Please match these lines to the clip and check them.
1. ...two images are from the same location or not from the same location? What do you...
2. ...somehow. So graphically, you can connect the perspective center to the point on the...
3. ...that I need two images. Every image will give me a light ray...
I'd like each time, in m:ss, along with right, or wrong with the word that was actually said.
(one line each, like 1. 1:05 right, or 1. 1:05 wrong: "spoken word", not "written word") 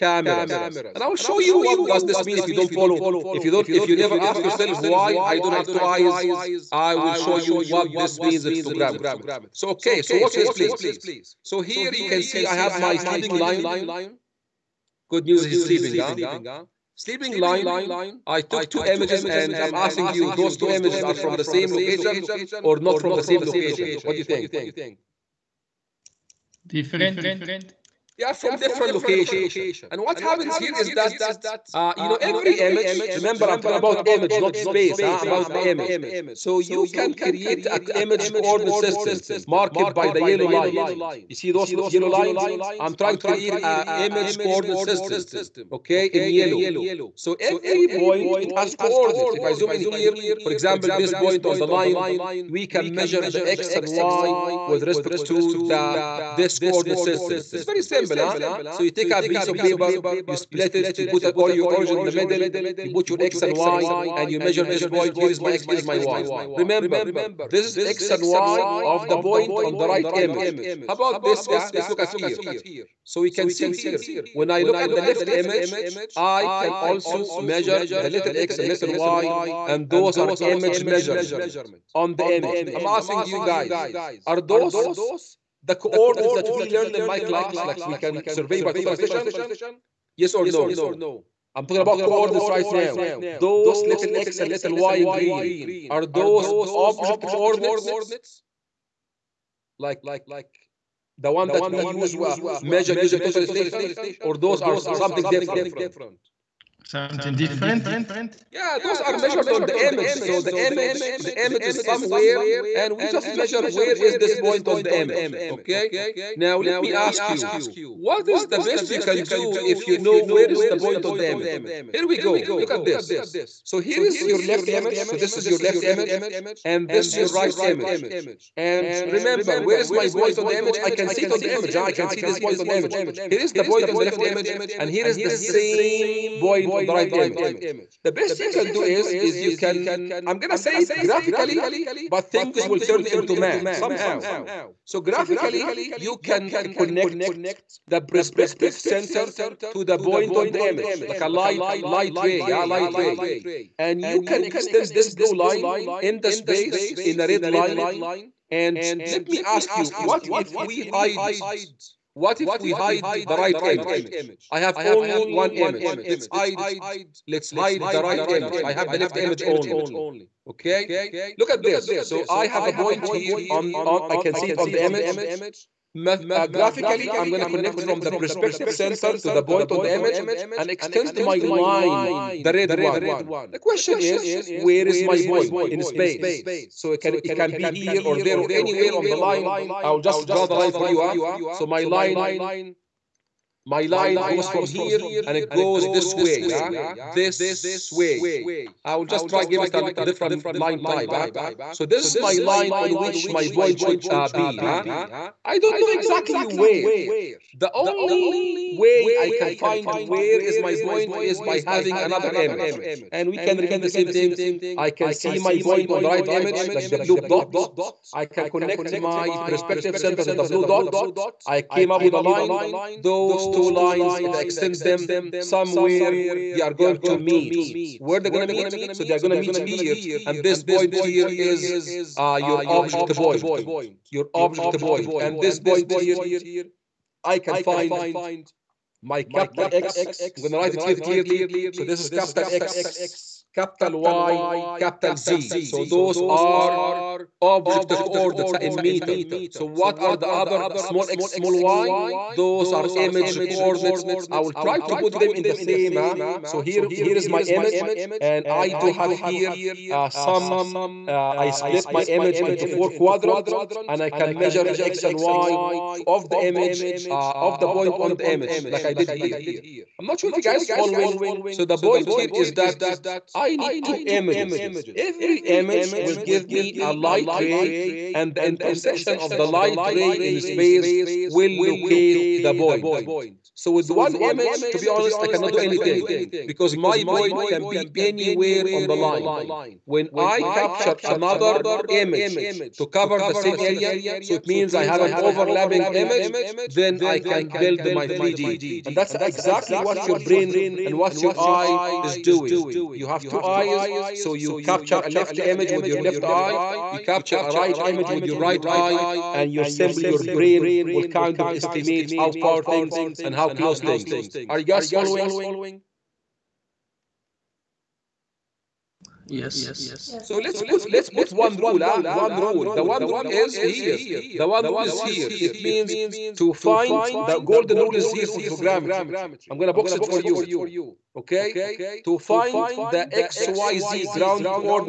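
1. 0:20 right
2. 2:23 right
3. 4:32 right.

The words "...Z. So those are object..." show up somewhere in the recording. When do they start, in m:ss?
4:05.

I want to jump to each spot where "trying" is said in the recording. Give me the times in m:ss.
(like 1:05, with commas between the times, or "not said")
0:42.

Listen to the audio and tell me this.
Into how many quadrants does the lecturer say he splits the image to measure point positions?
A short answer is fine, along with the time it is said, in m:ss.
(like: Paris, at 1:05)
4, at 4:22.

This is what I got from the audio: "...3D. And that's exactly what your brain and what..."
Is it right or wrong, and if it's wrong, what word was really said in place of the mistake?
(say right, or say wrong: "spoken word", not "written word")
right.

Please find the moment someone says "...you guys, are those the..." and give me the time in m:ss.
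1:23.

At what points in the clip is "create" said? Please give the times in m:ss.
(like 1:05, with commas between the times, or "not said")
0:37, 0:43.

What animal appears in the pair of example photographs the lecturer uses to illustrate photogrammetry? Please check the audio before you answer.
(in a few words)
Lion.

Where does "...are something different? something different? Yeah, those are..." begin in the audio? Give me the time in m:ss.
1:44.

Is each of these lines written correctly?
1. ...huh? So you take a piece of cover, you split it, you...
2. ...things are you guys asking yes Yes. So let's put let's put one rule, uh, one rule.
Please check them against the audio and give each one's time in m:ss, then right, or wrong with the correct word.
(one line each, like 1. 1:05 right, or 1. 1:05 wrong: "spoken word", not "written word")
1. 0:58 wrong: "paper", not "cover"
2. 5:13 wrong: "following", not "asking".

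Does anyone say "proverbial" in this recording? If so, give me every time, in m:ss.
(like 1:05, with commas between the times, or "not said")
not said.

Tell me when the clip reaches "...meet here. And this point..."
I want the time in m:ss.
3:49.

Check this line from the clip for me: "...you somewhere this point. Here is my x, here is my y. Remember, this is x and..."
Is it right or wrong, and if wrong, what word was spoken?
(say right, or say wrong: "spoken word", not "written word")
wrong: "measure", not "somewhere".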